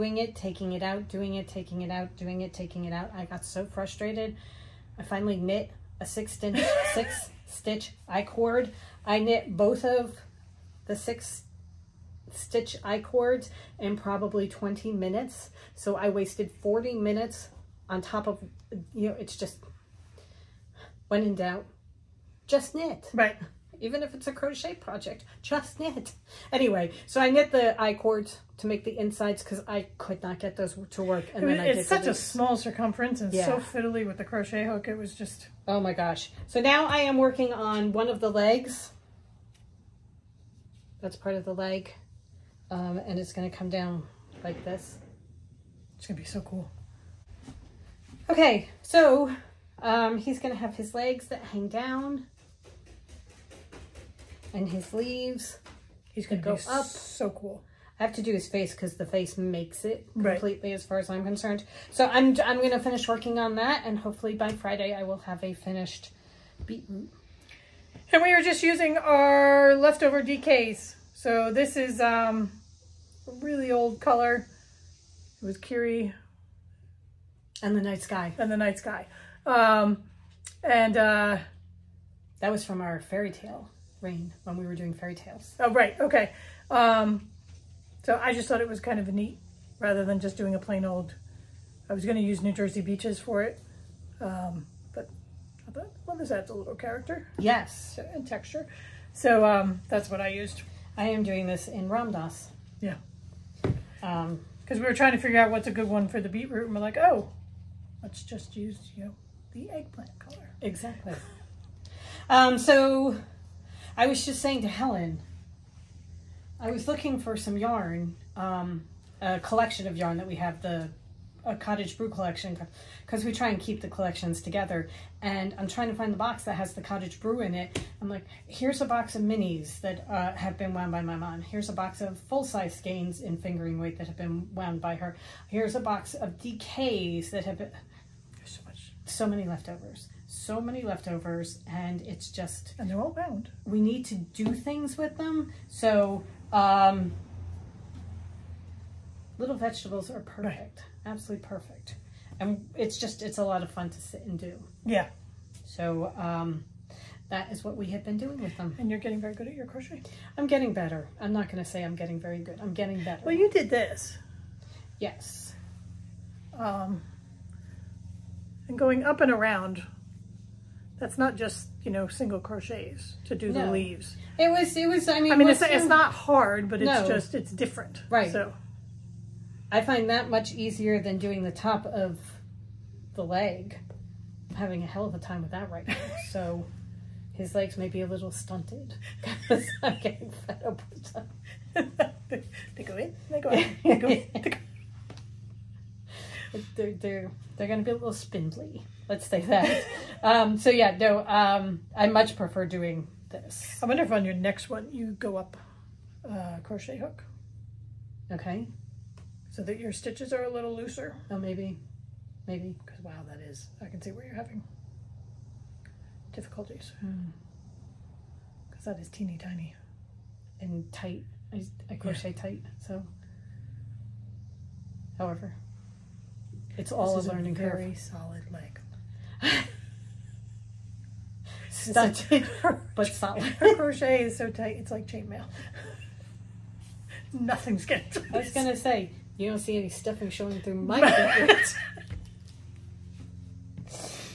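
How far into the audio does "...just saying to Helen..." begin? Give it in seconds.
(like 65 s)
114 s.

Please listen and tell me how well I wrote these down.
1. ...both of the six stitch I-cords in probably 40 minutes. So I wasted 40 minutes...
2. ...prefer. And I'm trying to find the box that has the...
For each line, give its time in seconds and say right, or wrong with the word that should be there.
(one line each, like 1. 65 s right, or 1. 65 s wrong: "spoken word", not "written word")
1. 9 s wrong: "20", not "40"
2. 124 s wrong: "together", not "prefer".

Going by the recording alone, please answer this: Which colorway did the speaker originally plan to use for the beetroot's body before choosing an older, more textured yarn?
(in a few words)
New Jersey Beaches.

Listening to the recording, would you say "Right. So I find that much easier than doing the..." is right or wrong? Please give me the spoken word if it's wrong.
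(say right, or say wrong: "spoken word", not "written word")
right.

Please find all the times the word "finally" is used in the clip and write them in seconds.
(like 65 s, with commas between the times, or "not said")
5 s.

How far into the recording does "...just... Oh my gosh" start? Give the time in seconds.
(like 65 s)
35 s.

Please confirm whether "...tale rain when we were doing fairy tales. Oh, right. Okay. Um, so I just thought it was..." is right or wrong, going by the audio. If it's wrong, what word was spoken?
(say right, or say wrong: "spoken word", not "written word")
right.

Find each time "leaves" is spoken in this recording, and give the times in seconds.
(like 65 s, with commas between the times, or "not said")
54 s, 173 s.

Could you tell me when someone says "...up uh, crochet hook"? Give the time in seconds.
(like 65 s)
205 s.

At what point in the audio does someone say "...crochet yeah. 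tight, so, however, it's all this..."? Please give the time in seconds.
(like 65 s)
221 s.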